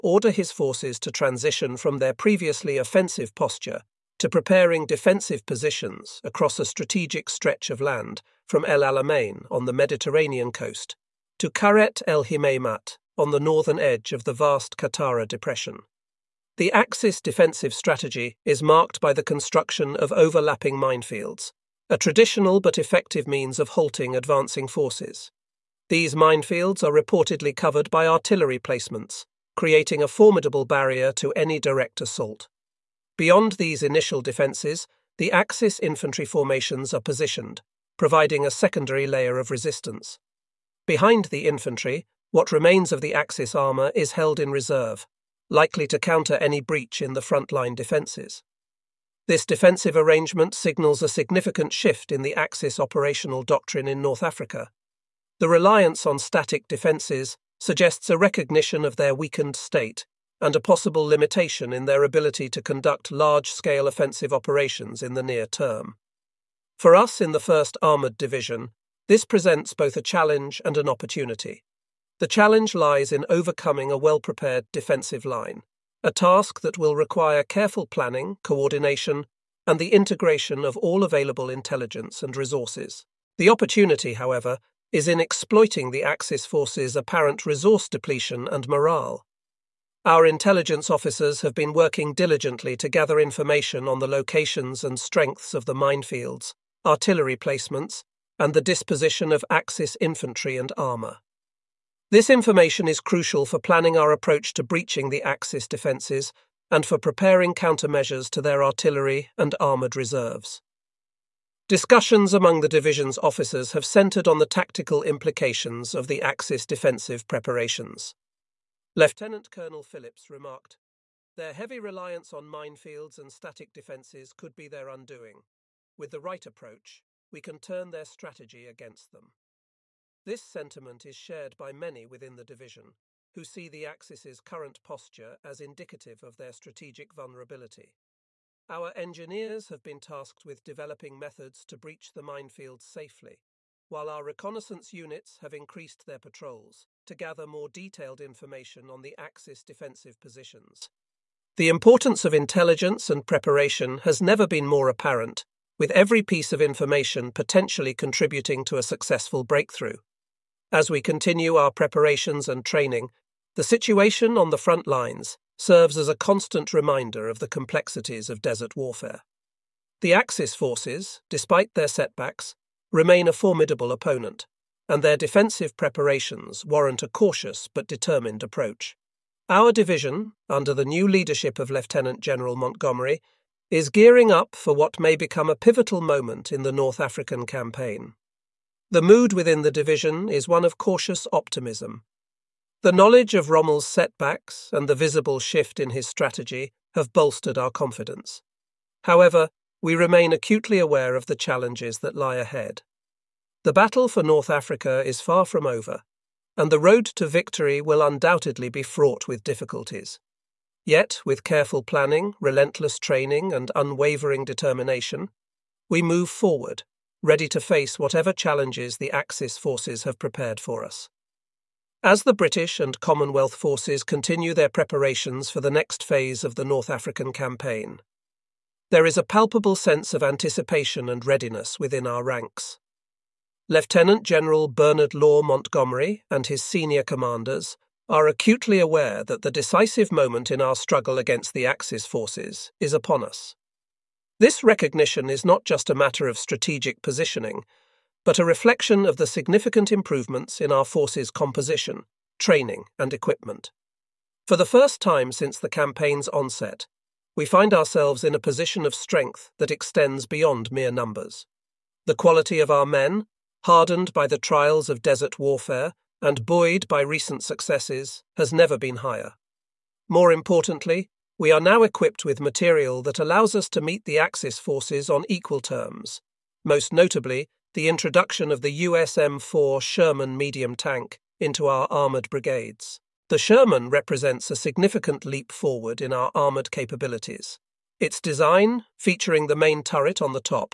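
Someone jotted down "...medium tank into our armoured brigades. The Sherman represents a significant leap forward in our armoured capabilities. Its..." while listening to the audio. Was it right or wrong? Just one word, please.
right.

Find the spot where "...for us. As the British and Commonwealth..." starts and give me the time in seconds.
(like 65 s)
220 s.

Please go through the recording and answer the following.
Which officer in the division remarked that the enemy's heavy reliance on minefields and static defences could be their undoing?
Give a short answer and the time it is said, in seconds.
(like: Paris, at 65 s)
Lieutenant Colonel Phillips, at 118 s.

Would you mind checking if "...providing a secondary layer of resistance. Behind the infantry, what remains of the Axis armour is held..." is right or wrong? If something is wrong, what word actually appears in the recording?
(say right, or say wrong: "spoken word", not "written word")
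right.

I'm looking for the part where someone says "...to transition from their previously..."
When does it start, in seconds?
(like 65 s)
0 s.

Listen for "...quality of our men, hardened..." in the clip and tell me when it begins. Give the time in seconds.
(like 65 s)
262 s.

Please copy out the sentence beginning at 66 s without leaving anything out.
For us in the 1st Armoured Division, this presents both a challenge and an opportunity.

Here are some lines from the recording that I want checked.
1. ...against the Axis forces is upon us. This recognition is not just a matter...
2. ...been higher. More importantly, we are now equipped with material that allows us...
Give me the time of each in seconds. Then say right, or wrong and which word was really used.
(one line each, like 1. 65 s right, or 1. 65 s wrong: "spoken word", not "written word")
1. 241 s right
2. 268 s right.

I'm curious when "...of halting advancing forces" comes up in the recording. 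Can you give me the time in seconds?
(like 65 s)
23 s.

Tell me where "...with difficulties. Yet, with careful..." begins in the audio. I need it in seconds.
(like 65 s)
209 s.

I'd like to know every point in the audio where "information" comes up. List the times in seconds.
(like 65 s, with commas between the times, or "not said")
93 s, 102 s, 148 s, 156 s.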